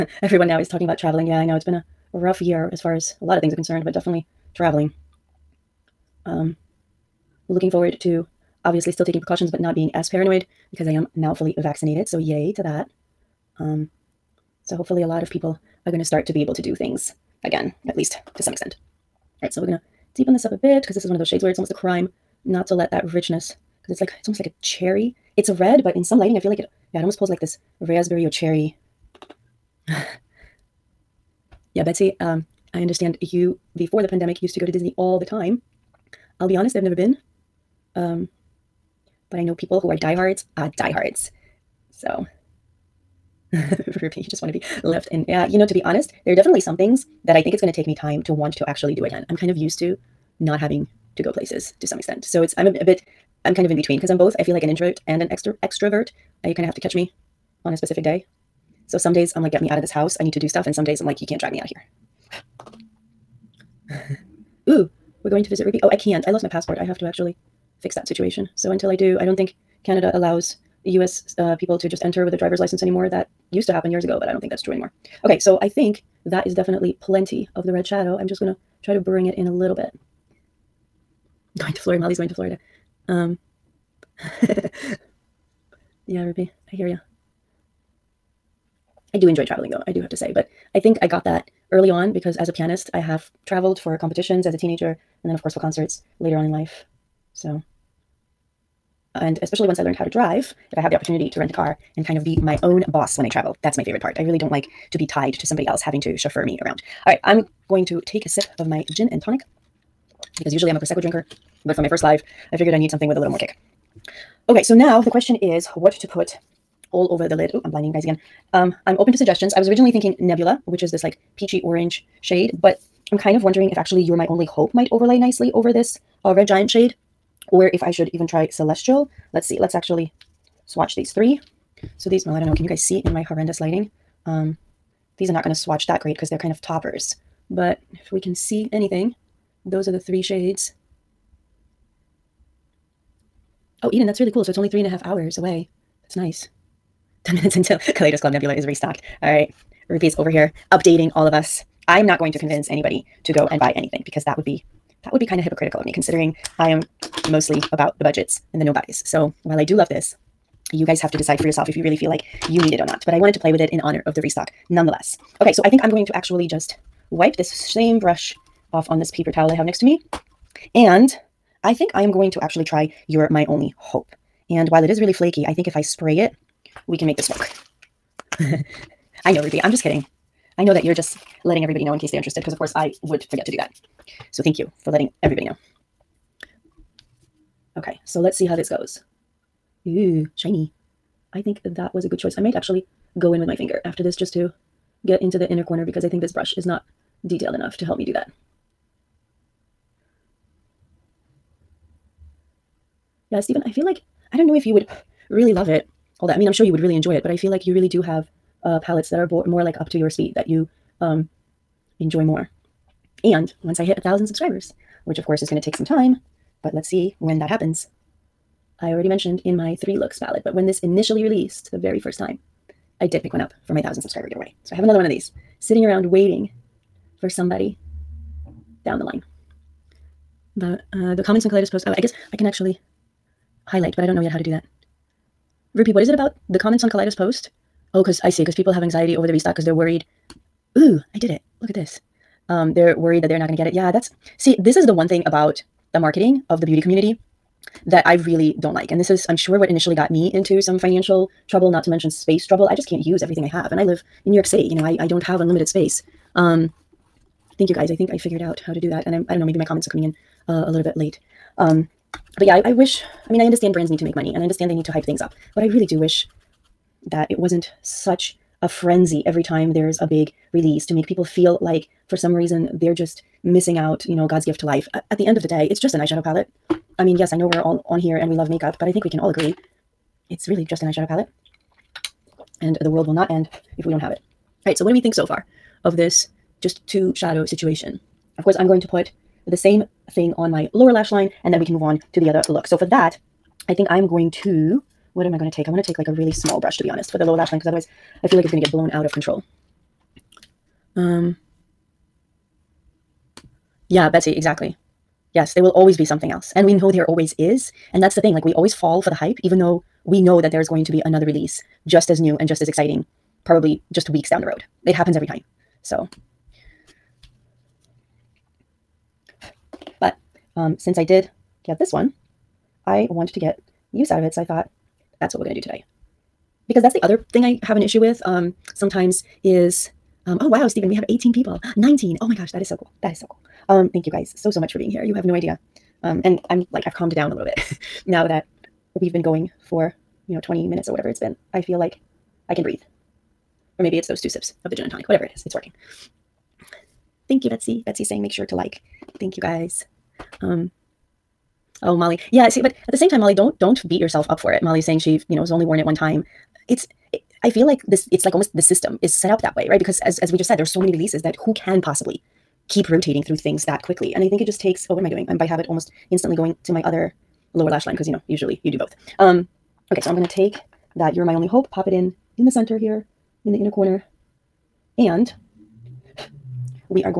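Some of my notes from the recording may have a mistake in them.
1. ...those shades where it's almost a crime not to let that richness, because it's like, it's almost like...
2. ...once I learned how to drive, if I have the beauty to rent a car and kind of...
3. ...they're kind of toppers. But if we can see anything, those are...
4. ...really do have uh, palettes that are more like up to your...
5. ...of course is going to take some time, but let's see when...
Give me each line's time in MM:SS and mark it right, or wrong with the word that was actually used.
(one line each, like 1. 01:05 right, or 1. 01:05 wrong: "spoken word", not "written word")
1. 00:21 right
2. 01:39 wrong: "opportunity", not "beauty"
3. 02:16 right
4. 03:27 right
5. 03:35 right.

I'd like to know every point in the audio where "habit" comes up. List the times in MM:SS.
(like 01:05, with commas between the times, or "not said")
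06:05.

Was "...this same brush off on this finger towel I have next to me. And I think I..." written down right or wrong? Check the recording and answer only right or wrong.
wrong.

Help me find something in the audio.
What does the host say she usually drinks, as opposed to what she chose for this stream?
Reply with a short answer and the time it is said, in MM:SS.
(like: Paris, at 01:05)
Prosecco, at 01:50.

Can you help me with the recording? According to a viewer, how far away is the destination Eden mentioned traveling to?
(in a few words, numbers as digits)
Three and a half hours.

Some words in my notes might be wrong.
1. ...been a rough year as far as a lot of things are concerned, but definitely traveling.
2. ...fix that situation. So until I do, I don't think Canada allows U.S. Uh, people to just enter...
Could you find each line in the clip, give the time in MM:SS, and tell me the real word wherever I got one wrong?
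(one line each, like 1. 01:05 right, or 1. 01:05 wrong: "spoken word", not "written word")
1. 00:01 right
2. 01:07 right.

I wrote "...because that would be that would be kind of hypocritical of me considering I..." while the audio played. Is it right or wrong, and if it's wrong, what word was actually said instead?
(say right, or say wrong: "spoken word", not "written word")
right.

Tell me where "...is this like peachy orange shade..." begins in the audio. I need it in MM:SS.
02:00.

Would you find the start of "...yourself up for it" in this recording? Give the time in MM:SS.
05:53.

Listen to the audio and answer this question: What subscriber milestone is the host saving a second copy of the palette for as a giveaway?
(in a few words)
1,000 subscribers.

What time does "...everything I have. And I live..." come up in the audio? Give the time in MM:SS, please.
04:13.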